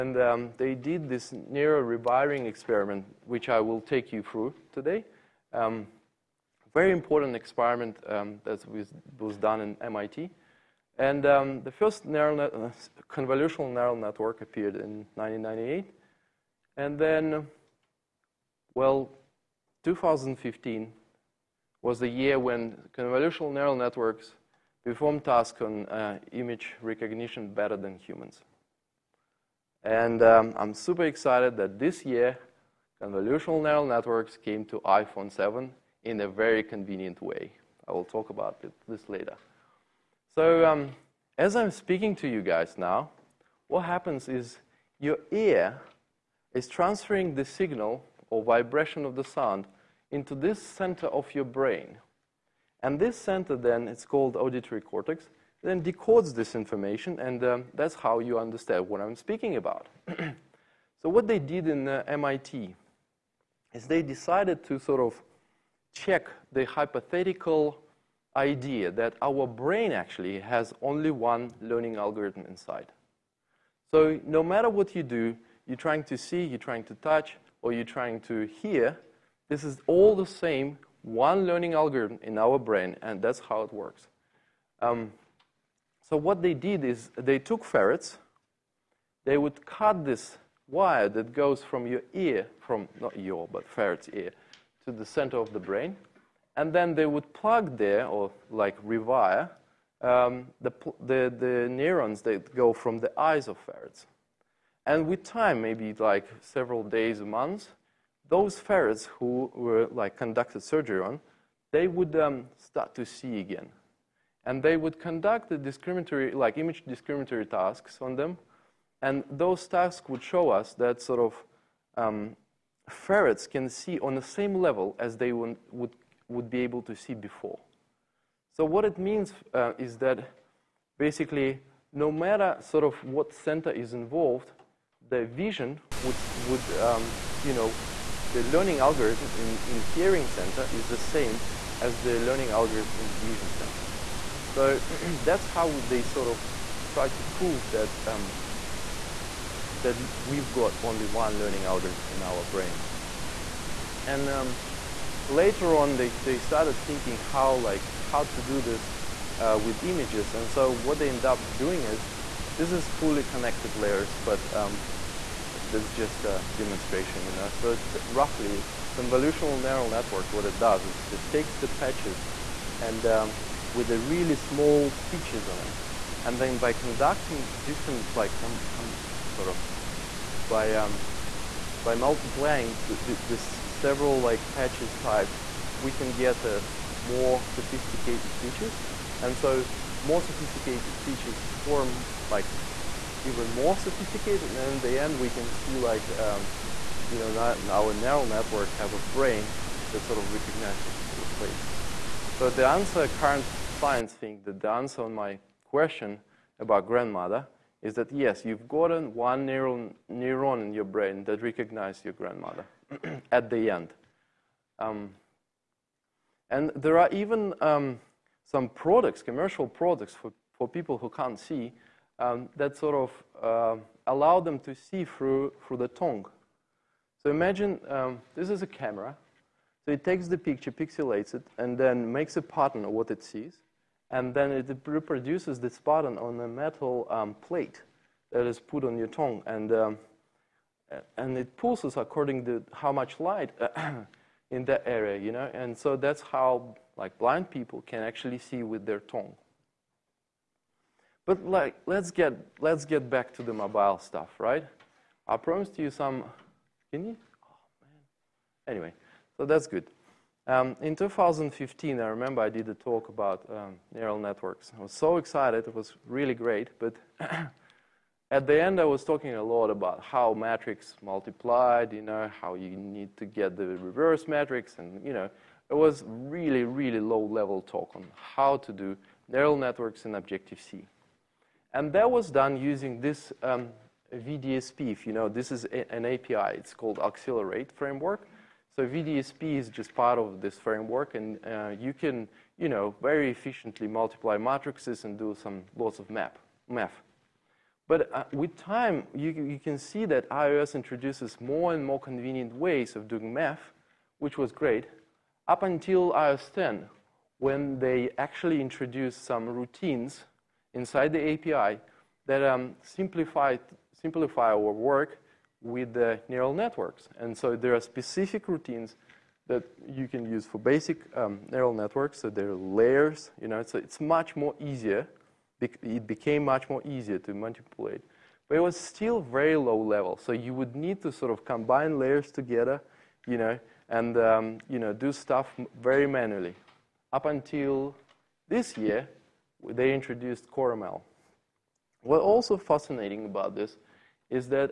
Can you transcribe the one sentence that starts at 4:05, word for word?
And so that's how like blind people can actually see with their tongue.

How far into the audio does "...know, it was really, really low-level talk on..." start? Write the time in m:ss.
4:35.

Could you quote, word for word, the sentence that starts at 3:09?
And so more sophisticated features form like even more sophisticated.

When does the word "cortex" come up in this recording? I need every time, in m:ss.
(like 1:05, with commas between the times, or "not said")
0:54.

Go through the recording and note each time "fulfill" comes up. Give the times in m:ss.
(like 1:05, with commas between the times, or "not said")
not said.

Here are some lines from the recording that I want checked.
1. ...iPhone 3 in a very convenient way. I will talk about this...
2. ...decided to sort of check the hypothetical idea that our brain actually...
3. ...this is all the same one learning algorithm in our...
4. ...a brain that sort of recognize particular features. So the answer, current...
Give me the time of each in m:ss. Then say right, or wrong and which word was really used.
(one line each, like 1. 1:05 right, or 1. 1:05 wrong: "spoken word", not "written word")
1. 0:34 wrong: "7", not "3"
2. 1:04 right
3. 1:19 right
4. 3:18 wrong: "faces", not "features".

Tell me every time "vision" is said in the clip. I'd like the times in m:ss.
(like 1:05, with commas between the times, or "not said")
2:15, 2:23.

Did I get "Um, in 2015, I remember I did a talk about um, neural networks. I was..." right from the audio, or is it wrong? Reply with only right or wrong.
right.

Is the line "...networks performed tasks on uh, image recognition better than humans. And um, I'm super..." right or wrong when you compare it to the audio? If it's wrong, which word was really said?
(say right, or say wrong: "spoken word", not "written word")
right.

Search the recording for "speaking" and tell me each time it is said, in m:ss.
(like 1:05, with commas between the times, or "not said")
0:41, 0:59.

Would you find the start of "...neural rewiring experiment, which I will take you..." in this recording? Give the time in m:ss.
0:01.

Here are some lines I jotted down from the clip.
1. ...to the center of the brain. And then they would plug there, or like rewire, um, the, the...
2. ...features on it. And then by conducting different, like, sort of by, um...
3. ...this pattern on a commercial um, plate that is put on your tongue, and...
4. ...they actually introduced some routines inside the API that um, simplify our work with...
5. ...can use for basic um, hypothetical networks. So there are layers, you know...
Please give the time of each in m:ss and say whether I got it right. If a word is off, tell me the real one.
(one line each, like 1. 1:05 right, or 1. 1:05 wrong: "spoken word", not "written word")
1. 1:34 right
2. 2:55 right
3. 3:55 wrong: "metal", not "commercial"
4. 5:07 right
5. 5:20 wrong: "neural", not "hypothetical".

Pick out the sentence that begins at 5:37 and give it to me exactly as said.
Up until this year, they introduced CoreML.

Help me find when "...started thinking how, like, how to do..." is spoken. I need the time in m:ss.
2:36.